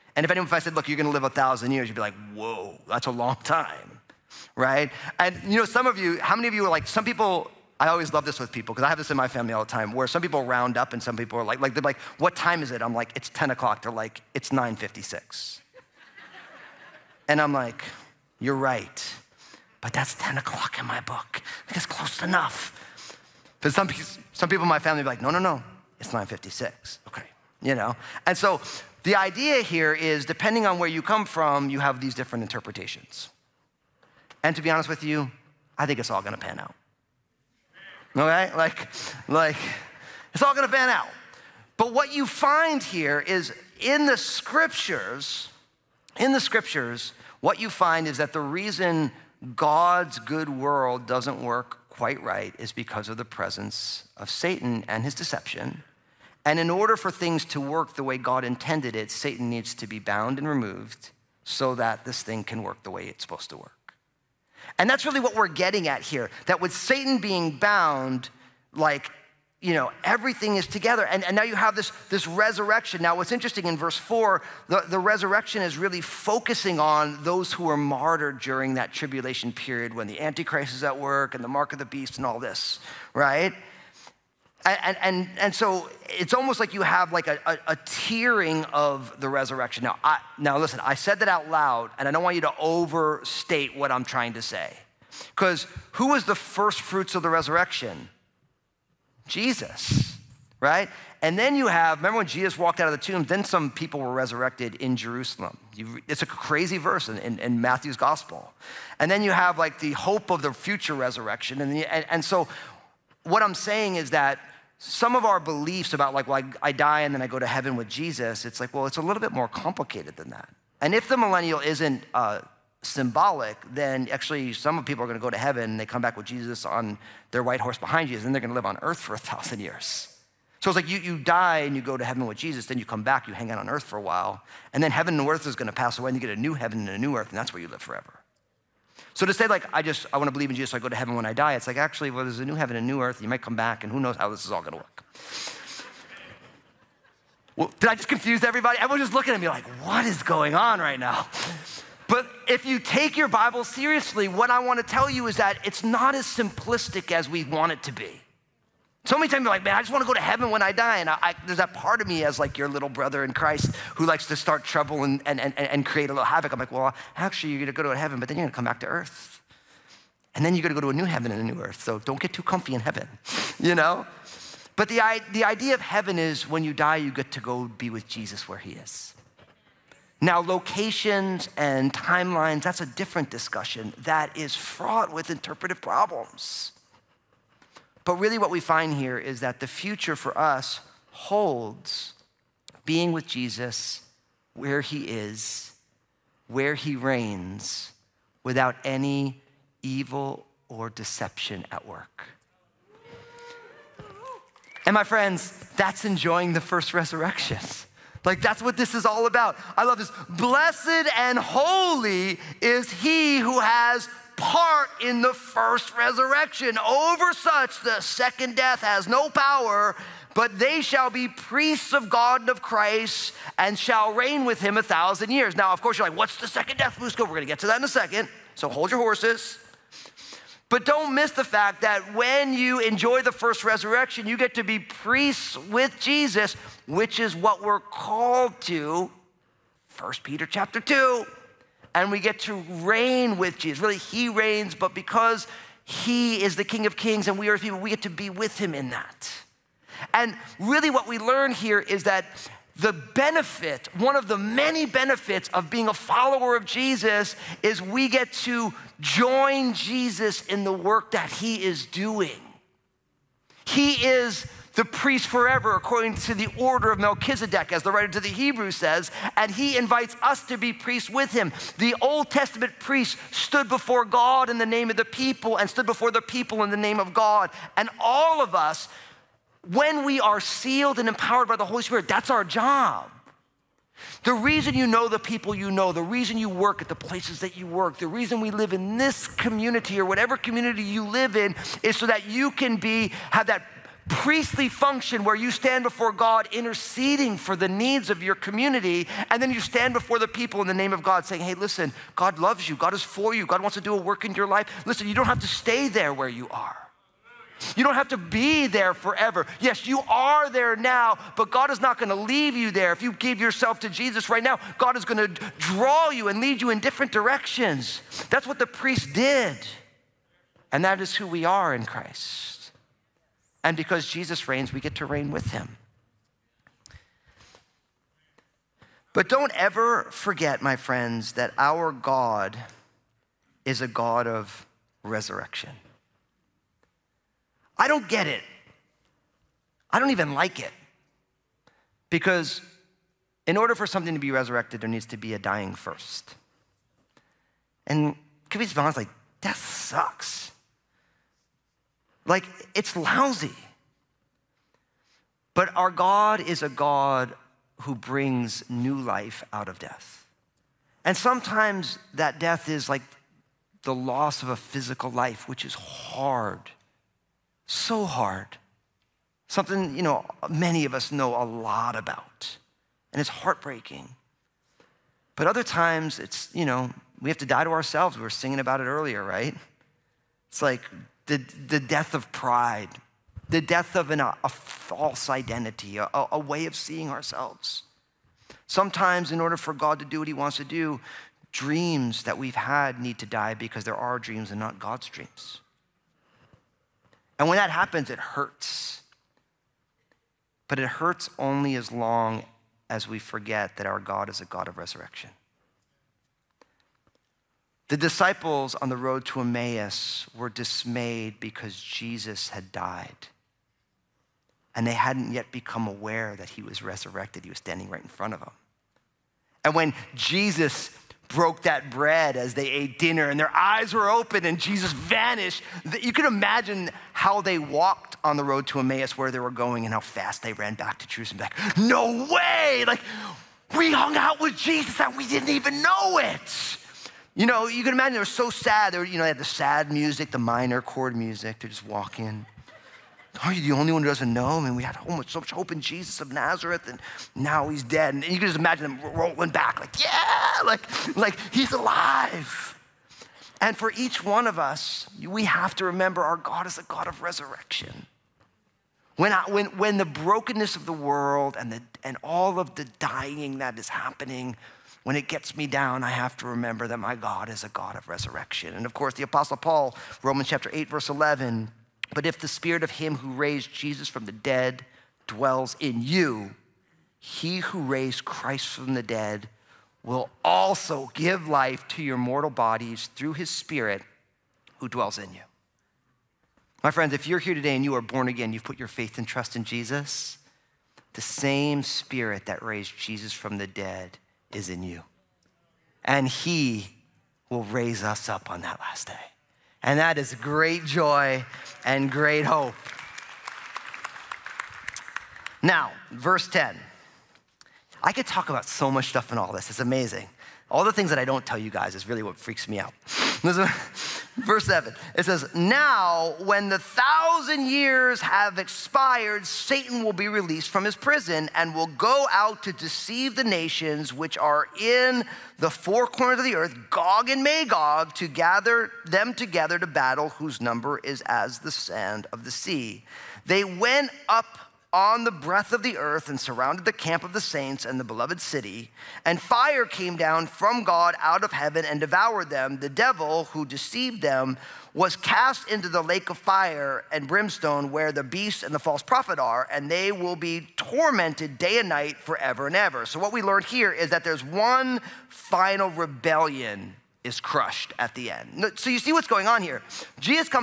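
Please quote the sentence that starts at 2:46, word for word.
I'm like, well, actually, you're going to go to heaven, but then you're going to come back to earth.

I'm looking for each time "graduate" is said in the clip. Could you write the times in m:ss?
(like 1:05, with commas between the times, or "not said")
not said.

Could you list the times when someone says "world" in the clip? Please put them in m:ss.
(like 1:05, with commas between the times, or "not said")
0:50, 7:40.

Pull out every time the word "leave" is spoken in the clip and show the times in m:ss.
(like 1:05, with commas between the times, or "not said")
5:12.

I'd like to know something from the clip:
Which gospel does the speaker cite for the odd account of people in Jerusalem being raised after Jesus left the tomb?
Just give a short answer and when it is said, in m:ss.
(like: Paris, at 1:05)
Matthew's gospel, at 1:47.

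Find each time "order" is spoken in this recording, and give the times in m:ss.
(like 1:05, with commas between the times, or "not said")
0:56, 4:26, 5:43, 6:29.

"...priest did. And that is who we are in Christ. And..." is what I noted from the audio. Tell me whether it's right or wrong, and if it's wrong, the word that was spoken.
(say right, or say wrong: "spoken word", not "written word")
right.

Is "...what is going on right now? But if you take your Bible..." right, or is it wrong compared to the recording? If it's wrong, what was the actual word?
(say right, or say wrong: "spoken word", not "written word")
right.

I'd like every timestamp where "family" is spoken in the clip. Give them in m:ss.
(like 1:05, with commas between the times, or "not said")
0:09, 0:24.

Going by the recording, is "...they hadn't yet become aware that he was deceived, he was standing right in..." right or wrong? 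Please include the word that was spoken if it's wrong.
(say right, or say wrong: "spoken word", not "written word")
wrong: "resurrected", not "deceived".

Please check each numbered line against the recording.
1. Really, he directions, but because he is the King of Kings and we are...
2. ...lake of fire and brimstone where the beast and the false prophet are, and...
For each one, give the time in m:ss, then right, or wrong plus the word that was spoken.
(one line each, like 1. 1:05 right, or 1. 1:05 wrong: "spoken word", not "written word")
1. 4:03 wrong: "reigns", not "directions"
2. 9:06 right.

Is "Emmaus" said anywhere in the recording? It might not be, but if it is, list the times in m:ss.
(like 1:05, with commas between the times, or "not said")
6:49, 7:08.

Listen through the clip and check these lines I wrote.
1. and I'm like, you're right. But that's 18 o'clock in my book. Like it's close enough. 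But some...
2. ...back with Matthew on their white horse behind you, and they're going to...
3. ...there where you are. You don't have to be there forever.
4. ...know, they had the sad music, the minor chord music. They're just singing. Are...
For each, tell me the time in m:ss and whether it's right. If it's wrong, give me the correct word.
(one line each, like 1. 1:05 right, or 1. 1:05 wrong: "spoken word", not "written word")
1. 0:17 wrong: "10", not "18"
2. 2:06 wrong: "Jesus", not "Matthew"
3. 5:05 right
4. 7:19 wrong: "walking", not "singing".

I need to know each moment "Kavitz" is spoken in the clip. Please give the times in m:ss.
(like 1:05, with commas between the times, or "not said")
5:48.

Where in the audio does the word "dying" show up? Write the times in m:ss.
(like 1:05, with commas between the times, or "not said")
5:45, 7:42.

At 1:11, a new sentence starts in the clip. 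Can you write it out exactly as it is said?
And, and now you have this, this resurrection.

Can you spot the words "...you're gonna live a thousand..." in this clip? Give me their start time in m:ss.
0:00.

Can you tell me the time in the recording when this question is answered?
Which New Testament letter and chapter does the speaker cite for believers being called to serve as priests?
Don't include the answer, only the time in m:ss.
3:59.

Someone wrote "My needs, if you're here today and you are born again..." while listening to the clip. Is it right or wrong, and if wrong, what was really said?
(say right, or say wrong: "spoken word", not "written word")
wrong: "friends", not "needs".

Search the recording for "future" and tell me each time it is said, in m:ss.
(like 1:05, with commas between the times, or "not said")
1:50, 3:09.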